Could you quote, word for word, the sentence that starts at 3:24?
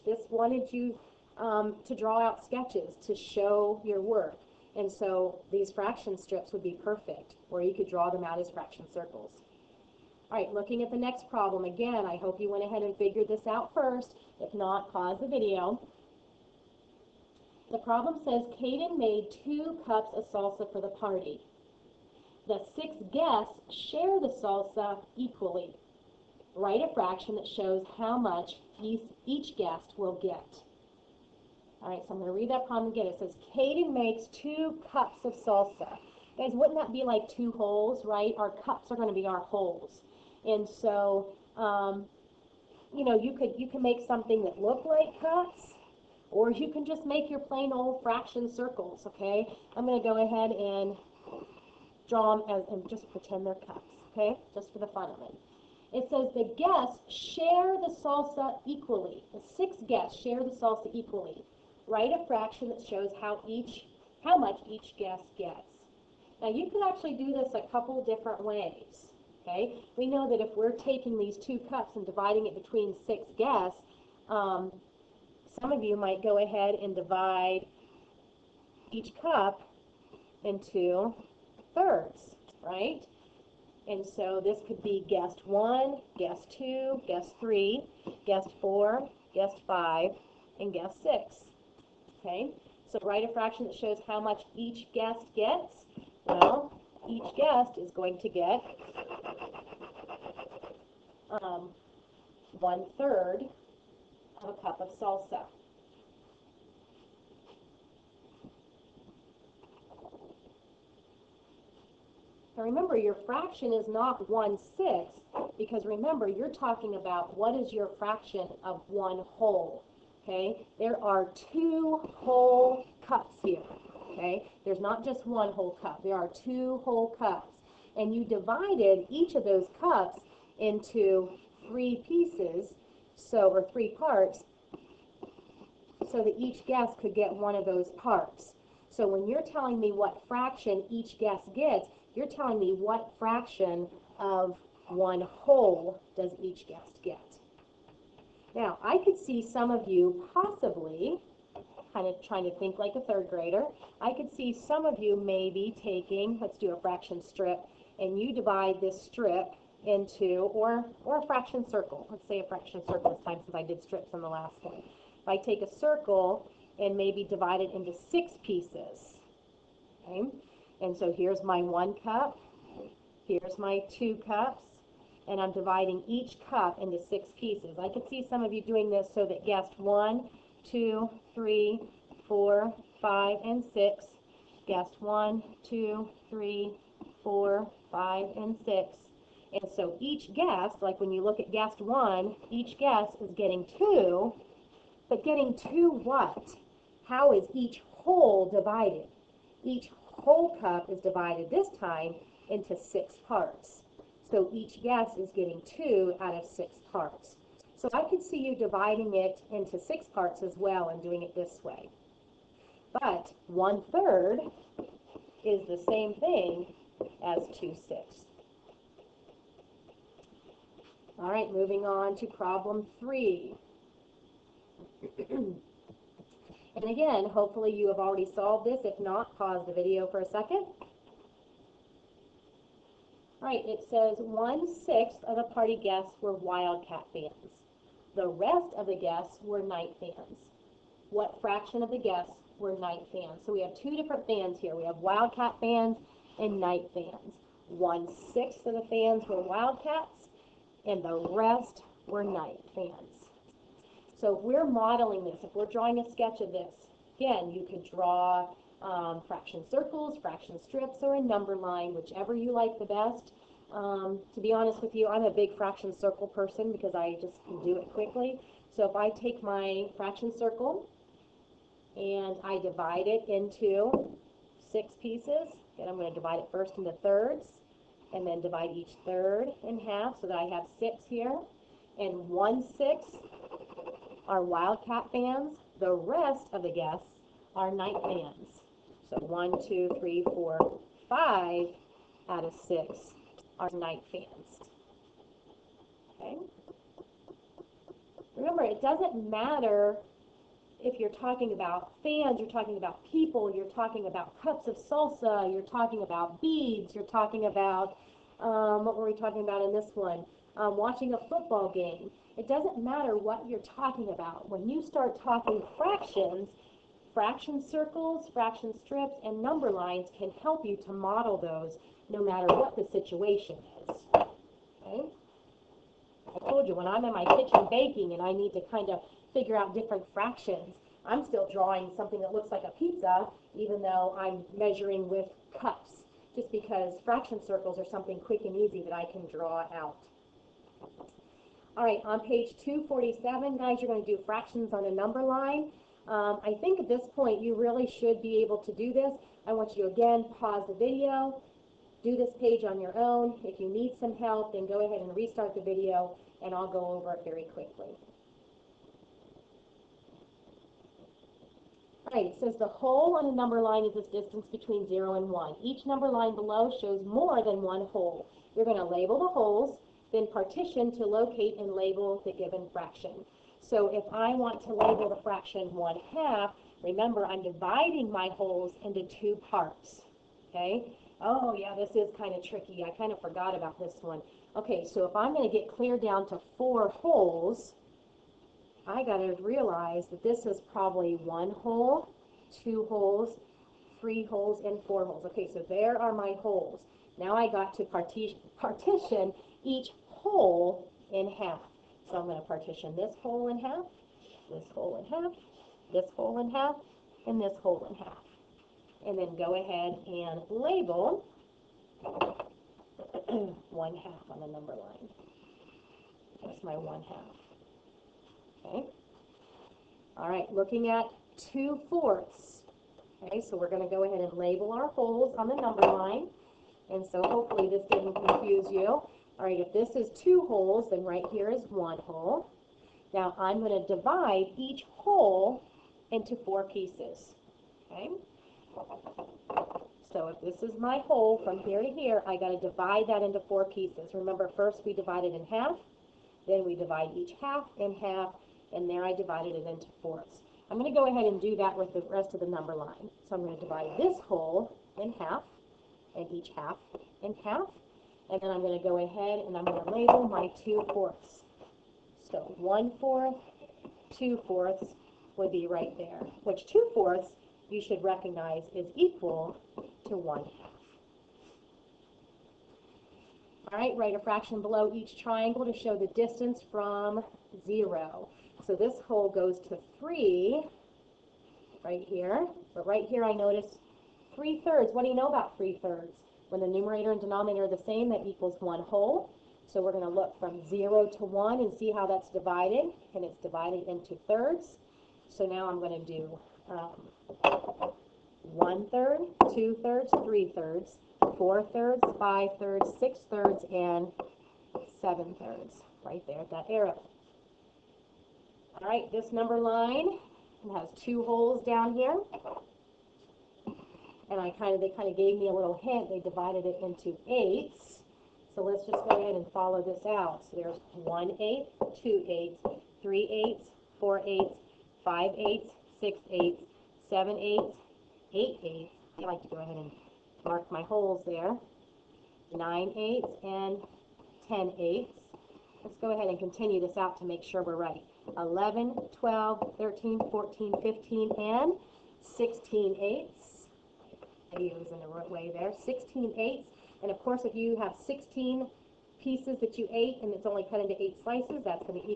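So each yes is getting two out of six parts.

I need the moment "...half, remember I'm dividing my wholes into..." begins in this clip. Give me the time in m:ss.
6:16.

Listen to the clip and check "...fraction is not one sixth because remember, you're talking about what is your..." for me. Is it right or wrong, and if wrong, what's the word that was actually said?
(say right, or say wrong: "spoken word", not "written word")
right.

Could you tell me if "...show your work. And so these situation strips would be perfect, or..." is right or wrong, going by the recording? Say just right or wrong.
wrong.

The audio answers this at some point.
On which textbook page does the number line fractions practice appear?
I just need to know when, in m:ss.
5:42.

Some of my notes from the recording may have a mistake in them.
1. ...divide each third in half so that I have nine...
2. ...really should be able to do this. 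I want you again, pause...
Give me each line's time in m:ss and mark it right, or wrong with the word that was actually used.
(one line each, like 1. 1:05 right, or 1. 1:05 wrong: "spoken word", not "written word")
1. 4:38 wrong: "six", not "nine"
2. 5:47 right.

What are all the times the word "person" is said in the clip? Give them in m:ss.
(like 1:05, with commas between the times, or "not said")
4:26.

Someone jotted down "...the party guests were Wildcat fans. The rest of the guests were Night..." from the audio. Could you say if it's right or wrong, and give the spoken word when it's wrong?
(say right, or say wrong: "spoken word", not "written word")
right.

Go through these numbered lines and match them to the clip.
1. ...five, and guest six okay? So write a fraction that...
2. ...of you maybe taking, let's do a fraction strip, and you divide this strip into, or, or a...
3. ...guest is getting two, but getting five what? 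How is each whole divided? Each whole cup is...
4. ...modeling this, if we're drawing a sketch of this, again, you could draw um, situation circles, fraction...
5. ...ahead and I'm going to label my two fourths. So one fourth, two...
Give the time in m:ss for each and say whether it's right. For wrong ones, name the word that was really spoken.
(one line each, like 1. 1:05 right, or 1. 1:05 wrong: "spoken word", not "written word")
1. 1:29 right
2. 2:34 right
3. 3:12 wrong: "two", not "five"
4. 4:14 wrong: "fraction", not "situation"
5. 7:39 right.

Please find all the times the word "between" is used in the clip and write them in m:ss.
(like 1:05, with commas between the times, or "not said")
1:12, 6:04.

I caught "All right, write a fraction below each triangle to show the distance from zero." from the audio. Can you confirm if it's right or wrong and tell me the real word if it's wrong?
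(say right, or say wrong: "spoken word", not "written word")
right.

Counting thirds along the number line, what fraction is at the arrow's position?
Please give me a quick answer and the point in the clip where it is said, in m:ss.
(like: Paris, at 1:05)
7/3, at 8:25.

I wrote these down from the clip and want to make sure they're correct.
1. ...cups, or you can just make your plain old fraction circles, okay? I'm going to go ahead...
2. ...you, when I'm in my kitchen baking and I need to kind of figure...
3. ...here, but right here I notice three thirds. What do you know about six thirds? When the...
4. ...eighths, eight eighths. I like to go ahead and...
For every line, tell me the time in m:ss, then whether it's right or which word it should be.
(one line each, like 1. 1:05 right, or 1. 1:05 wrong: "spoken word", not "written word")
1. 0:45 right
2. 5:26 right
3. 8:02 wrong: "three", not "six"
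4. 8:47 right.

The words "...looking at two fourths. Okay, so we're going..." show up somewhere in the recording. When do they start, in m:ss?
7:00.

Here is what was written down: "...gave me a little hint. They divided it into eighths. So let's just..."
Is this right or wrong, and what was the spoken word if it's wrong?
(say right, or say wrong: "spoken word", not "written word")
right.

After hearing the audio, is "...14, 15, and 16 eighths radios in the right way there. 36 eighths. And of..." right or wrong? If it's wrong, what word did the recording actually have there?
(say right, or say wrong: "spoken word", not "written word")
wrong: "16", not "36".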